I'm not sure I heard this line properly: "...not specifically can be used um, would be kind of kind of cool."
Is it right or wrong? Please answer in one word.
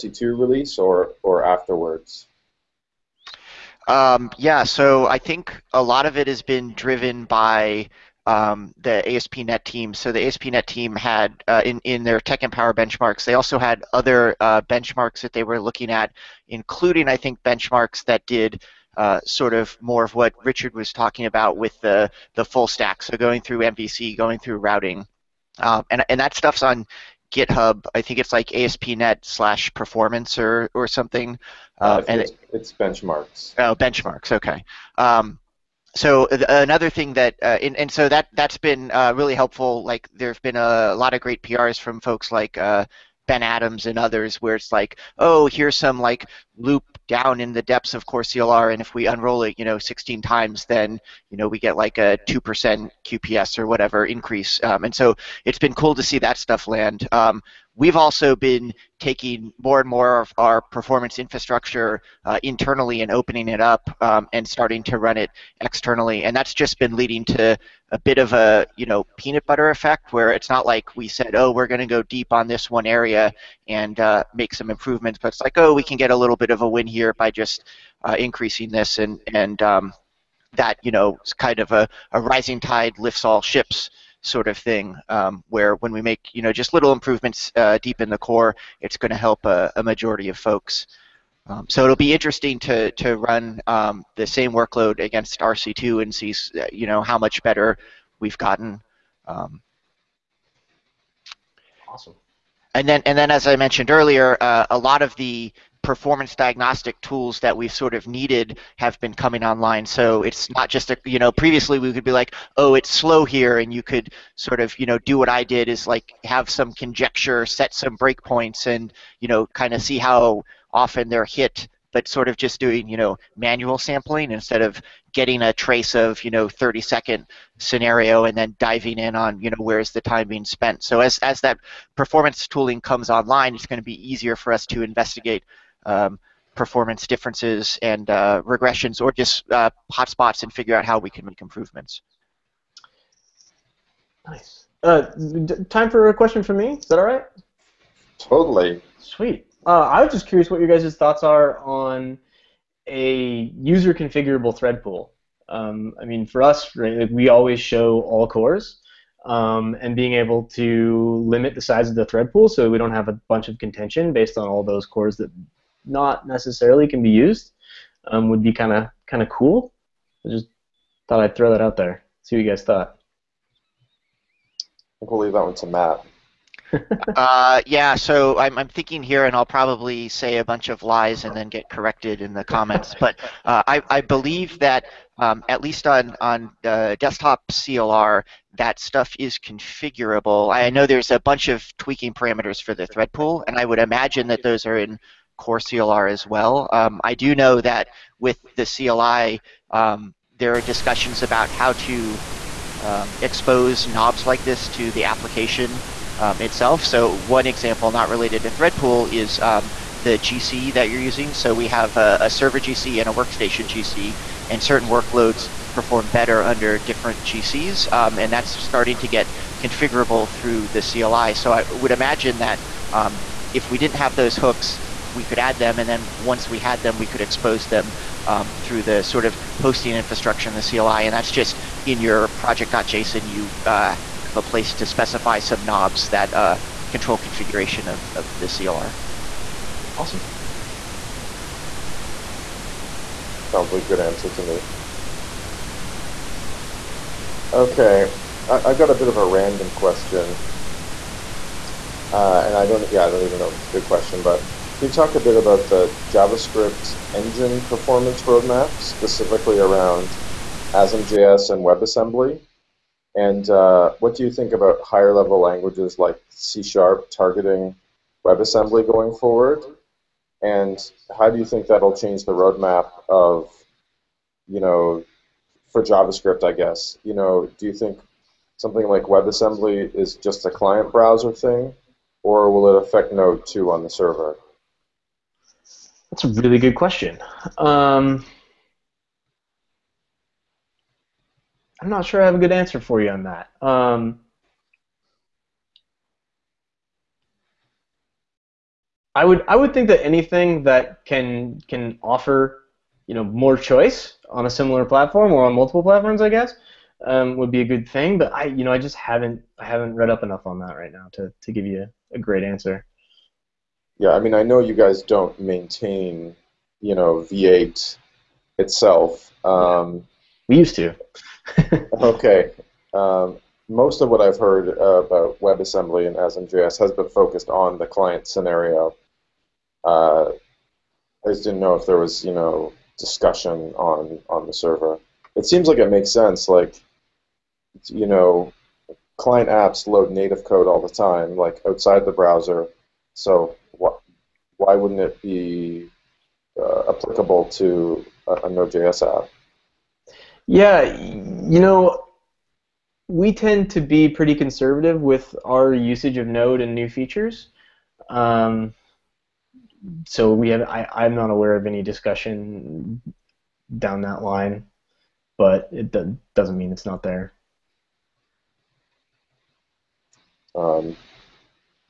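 wrong.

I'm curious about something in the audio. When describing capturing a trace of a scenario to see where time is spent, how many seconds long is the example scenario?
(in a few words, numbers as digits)
30 seconds.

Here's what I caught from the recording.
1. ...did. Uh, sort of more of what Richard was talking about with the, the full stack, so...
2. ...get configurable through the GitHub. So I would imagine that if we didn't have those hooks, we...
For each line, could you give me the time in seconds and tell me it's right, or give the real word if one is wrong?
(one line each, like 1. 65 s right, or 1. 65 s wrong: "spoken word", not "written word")
1. 18 s right
2. 219 s wrong: "CLI", not "GitHub".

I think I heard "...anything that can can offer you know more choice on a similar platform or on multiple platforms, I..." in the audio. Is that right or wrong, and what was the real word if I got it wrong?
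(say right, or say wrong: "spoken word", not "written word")
right.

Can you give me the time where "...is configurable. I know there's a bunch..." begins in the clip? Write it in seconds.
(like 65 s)
189 s.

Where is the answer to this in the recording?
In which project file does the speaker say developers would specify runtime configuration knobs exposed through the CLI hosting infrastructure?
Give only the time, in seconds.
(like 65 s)
232 s.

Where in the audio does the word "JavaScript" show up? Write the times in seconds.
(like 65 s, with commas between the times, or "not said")
256 s, 275 s.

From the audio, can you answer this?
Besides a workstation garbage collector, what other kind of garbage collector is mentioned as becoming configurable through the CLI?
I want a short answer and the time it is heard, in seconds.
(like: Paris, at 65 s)
server GC, at 212 s.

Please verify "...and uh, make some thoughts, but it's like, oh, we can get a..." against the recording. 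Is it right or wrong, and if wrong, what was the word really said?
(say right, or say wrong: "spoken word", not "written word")
wrong: "improvements", not "thoughts".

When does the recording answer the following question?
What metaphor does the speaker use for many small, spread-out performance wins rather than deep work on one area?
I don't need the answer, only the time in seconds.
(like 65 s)
69 s.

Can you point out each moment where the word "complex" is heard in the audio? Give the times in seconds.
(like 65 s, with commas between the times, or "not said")
not said.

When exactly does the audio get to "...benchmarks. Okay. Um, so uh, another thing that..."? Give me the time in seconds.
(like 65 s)
33 s.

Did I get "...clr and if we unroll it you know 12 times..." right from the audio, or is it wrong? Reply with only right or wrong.
wrong.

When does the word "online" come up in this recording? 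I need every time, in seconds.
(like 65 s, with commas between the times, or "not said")
109 s, 133 s.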